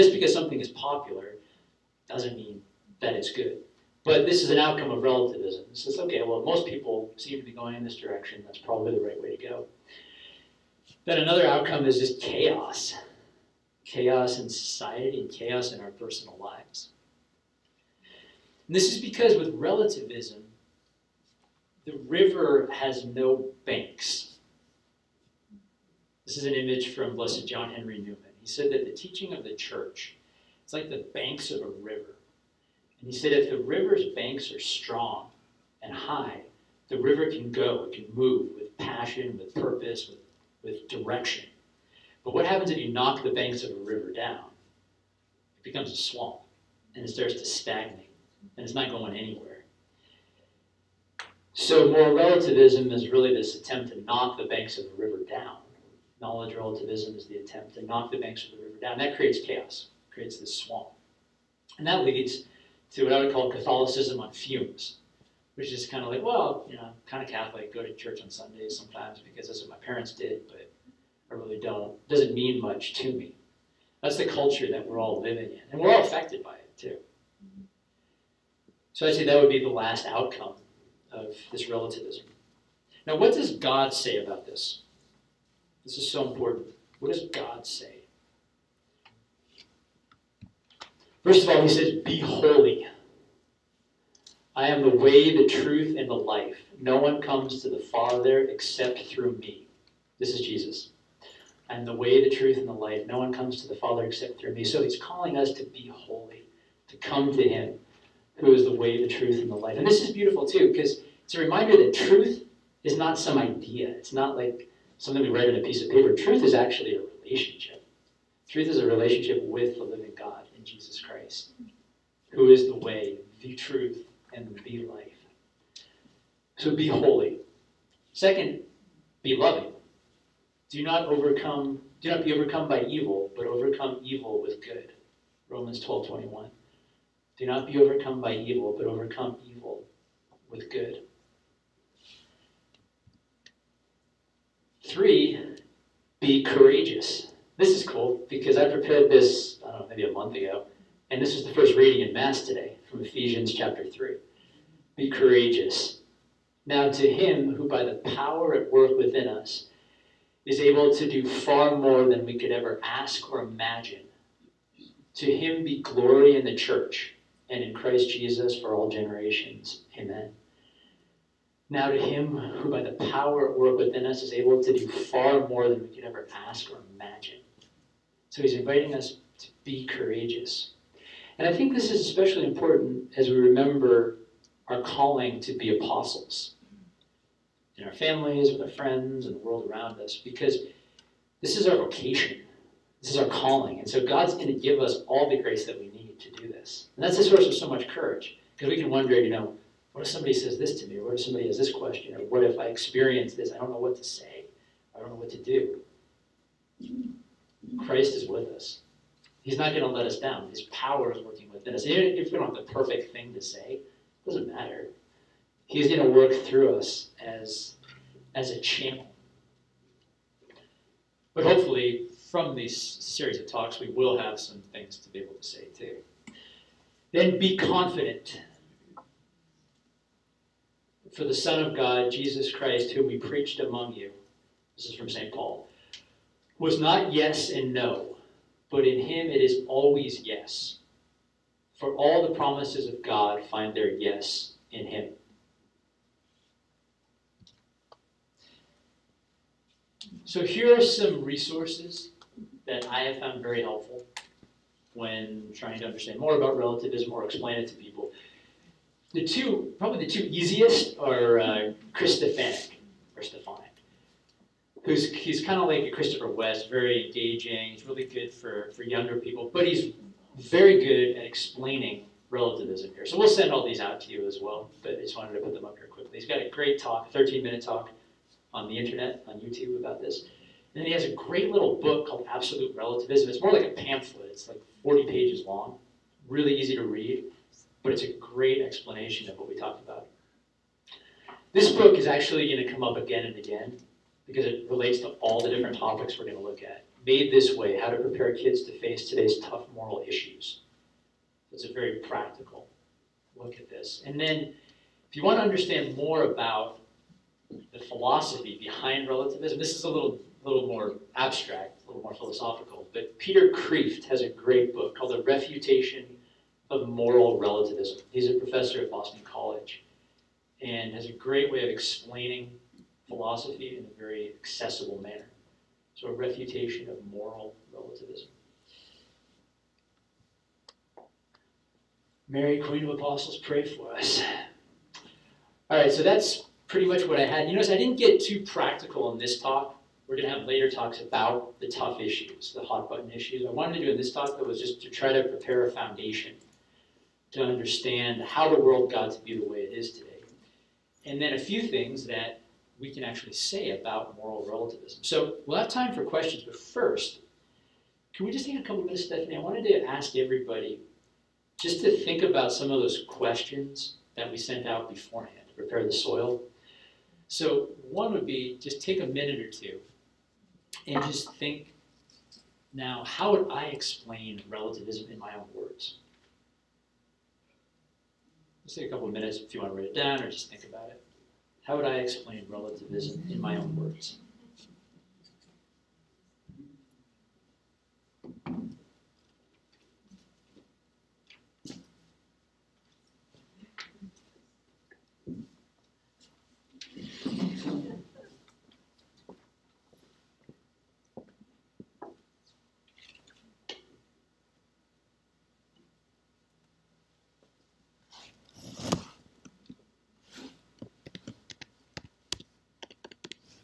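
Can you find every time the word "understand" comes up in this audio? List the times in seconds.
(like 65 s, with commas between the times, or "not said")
255 s, 305 s, 347 s.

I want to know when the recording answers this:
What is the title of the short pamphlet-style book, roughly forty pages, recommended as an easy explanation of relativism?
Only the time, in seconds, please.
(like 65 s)
282 s.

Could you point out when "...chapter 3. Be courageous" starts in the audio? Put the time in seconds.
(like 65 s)
153 s.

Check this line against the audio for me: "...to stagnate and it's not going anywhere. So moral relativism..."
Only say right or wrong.
right.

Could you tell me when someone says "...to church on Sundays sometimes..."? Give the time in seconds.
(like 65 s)
67 s.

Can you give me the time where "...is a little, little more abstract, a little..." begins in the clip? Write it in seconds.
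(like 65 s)
309 s.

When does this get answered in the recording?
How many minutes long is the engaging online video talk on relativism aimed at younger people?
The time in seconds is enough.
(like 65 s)
277 s.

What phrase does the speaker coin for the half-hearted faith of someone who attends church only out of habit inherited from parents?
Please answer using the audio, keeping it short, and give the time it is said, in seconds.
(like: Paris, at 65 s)
Catholicism on fumes, at 63 s.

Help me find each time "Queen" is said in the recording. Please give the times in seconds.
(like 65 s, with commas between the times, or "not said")
332 s.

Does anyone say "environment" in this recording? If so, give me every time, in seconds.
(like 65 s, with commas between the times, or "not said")
not said.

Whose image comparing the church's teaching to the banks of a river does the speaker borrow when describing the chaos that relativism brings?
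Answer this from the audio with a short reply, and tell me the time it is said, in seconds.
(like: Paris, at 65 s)
John Henry Newman, at 27 s.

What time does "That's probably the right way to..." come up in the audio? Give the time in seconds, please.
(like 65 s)
8 s.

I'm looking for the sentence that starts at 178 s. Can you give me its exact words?
So he's inviting us to be courageous.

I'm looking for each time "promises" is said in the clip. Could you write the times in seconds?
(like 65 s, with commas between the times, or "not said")
242 s.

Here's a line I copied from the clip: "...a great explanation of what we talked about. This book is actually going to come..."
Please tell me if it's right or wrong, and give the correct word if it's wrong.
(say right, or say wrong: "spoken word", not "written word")
right.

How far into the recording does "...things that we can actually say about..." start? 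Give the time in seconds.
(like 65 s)
351 s.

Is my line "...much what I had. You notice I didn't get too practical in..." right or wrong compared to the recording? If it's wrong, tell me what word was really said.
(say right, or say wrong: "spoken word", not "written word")
right.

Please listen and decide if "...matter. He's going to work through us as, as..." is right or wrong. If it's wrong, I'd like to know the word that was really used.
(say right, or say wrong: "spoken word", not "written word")
right.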